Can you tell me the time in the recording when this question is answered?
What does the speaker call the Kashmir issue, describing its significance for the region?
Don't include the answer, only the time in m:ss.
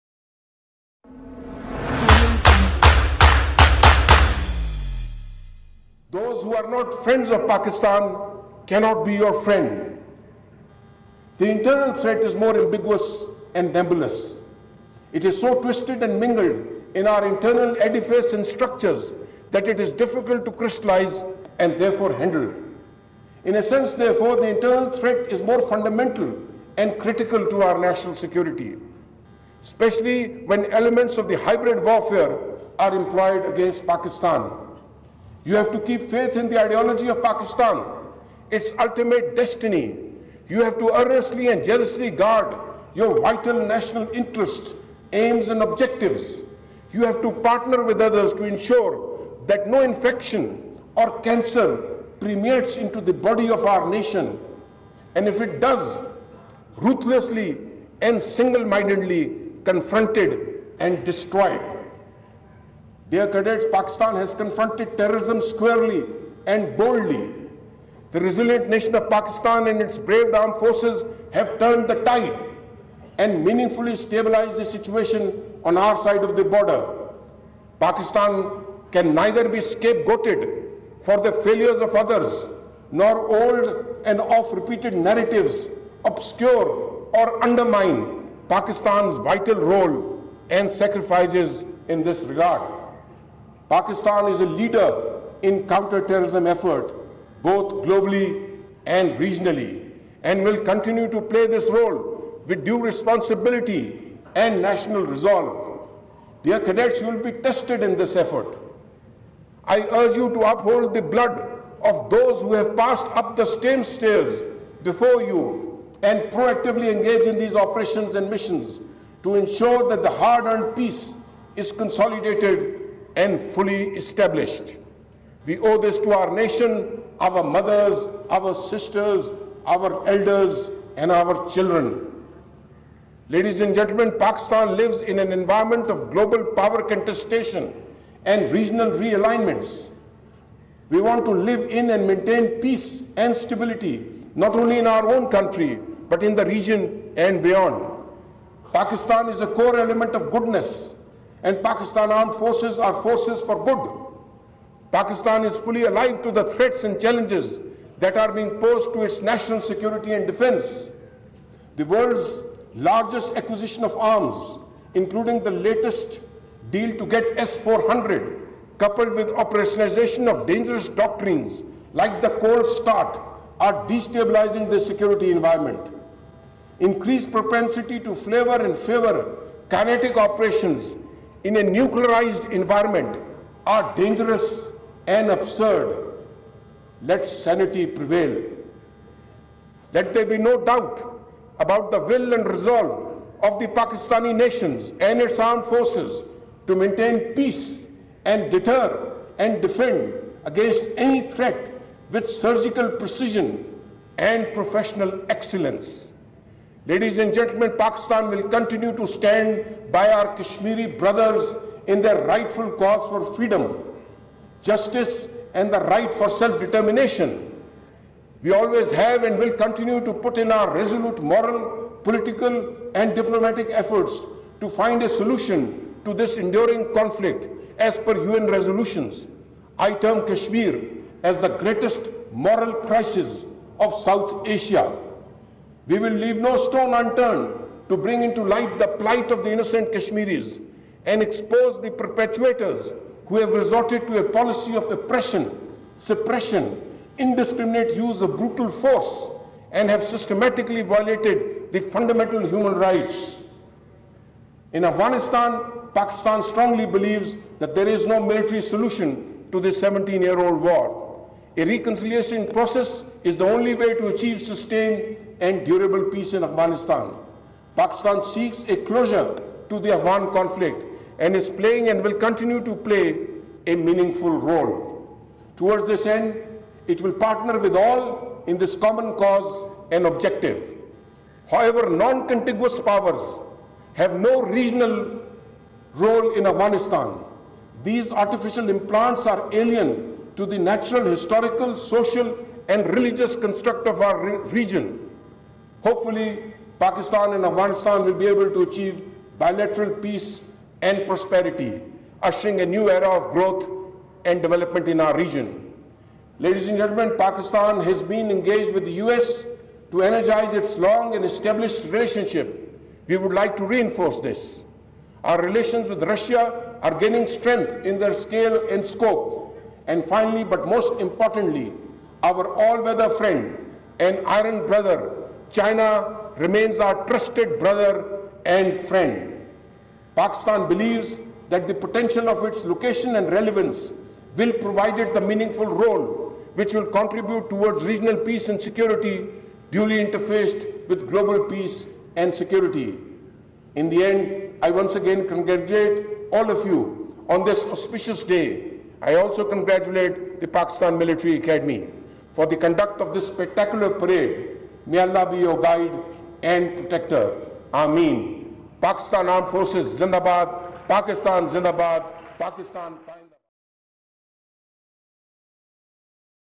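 3:51.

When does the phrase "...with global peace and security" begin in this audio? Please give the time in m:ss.
5:40.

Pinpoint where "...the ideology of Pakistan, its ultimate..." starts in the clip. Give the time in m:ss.
0:36.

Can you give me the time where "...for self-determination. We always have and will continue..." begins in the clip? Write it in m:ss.
3:36.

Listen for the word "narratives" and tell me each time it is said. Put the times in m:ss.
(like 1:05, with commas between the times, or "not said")
1:24.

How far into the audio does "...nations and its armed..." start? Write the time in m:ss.
3:14.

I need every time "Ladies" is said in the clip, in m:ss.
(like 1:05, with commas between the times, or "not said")
2:13, 3:26, 5:06.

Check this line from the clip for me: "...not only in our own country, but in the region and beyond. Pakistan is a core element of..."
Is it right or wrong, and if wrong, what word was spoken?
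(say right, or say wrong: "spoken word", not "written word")
right.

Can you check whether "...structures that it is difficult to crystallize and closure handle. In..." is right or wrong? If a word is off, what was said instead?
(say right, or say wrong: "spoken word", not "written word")
wrong: "therefore", not "closure".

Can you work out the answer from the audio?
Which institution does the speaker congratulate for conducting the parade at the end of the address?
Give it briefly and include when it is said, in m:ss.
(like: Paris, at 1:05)
Pakistan Military Academy, at 5:50.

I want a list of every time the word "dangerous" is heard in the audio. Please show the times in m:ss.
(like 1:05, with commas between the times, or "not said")
2:50, 3:03.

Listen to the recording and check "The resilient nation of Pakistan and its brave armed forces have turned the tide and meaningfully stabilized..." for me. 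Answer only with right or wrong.
right.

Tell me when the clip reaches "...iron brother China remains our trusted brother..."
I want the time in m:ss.
5:24.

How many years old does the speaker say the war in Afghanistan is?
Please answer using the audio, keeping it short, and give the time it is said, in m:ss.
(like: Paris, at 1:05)
17, at 4:19.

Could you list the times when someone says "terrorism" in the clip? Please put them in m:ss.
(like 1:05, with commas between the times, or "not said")
1:04, 1:35.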